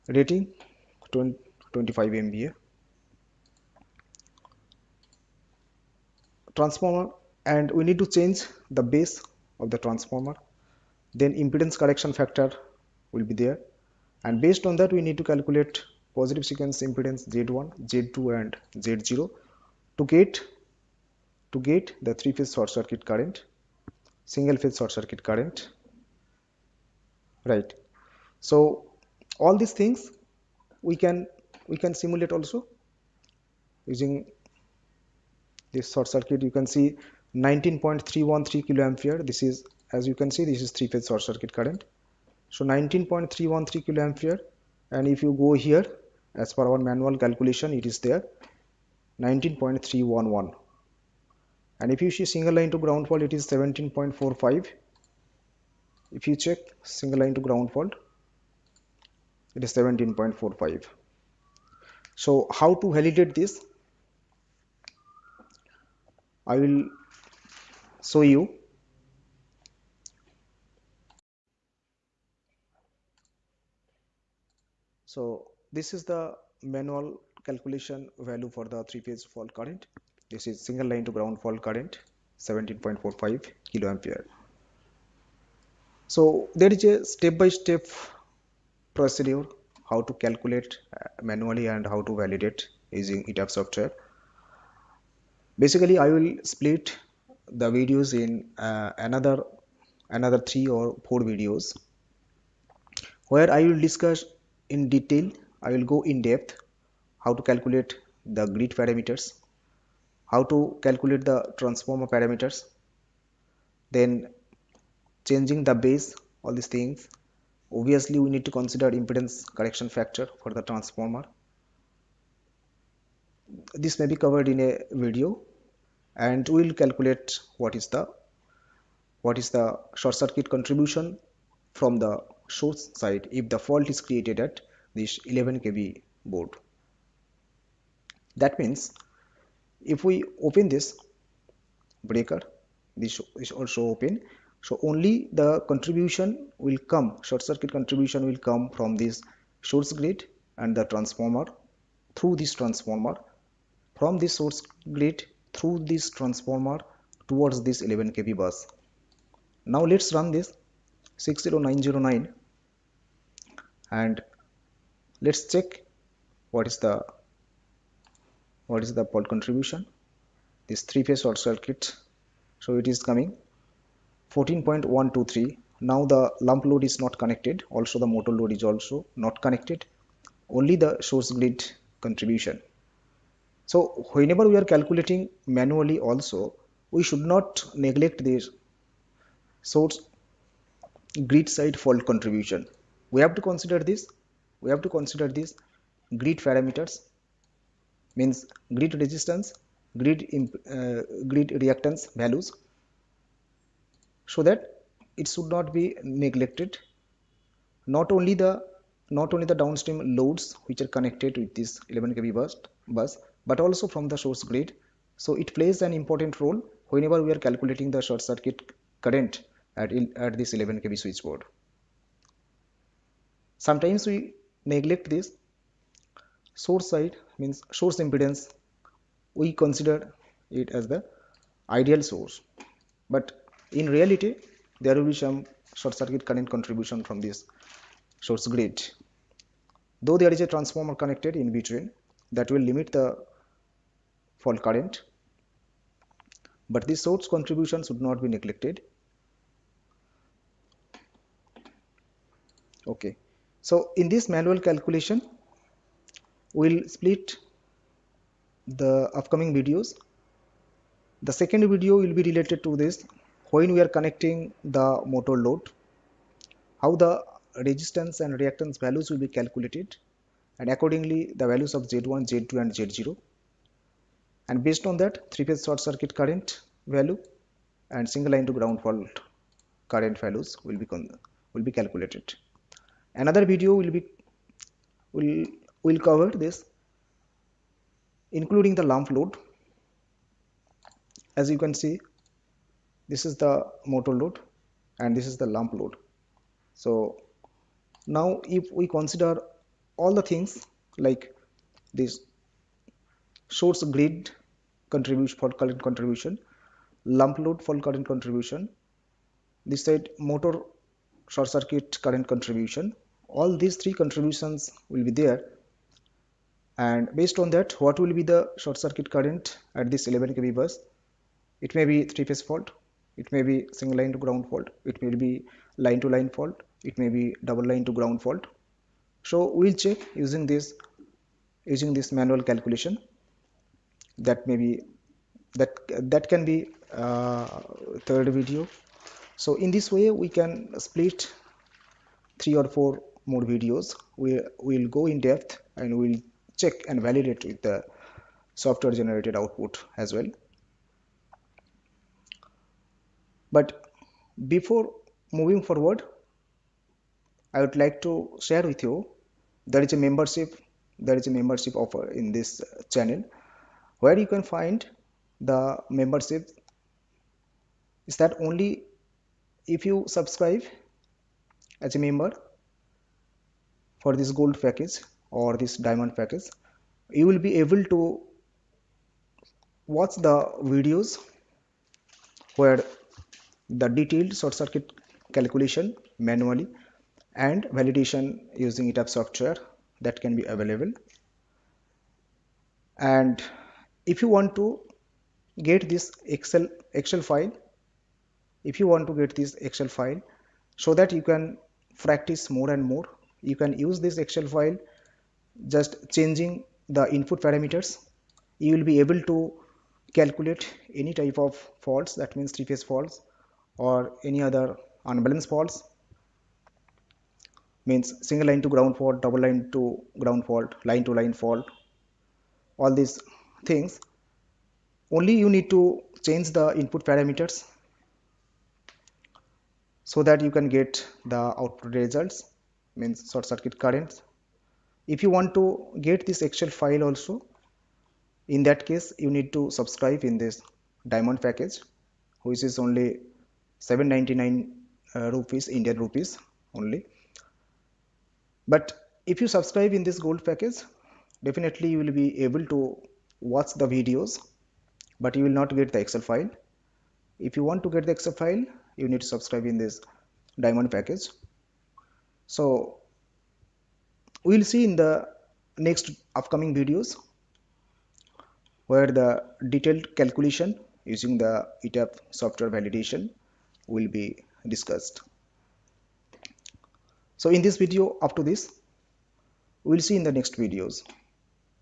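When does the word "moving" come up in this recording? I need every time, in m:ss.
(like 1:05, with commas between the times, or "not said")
5:55.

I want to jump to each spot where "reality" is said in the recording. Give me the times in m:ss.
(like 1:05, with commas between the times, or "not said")
3:53.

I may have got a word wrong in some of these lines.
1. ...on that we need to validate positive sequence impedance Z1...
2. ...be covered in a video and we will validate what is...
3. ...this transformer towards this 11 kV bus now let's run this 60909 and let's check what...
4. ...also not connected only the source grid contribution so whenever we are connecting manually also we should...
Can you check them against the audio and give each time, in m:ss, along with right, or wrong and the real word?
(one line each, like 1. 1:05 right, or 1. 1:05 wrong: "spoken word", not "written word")
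1. 0:14 wrong: "calculate", not "validate"
2. 2:04 wrong: "calculate", not "validate"
3. 2:35 right
4. 2:58 wrong: "calculating", not "connecting".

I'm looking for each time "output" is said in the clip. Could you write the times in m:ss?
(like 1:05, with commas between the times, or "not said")
5:49, 7:11.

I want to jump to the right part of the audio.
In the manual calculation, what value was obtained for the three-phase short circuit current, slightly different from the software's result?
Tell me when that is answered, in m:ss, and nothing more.
0:48.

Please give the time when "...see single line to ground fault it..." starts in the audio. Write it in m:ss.
0:52.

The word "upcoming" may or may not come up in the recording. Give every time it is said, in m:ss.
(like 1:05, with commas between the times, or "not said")
4:19, 7:46.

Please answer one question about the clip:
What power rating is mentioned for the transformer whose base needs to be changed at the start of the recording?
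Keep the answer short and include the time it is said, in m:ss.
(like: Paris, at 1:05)
25 MVA, at 0:01.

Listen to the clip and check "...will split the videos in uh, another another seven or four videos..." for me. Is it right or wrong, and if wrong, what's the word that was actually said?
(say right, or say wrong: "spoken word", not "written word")
wrong: "three", not "seven".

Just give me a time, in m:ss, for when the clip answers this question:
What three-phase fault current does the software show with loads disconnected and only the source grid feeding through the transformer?
2:54.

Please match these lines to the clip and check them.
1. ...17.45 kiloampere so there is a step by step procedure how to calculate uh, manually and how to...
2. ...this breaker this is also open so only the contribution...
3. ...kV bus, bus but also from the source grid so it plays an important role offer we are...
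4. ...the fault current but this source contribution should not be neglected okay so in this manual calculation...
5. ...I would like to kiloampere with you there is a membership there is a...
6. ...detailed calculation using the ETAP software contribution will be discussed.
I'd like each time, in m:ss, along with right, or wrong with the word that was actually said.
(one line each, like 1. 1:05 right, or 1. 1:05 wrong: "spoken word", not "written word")
1. 1:22 right
2. 2:20 right
3. 3:32 wrong: "whenever", not "offer"
4. 4:02 right
5. 5:57 wrong: "share", not "kiloampere"
6. 7:49 wrong: "validation", not "contribution".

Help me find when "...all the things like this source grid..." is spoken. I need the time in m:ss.
4:59.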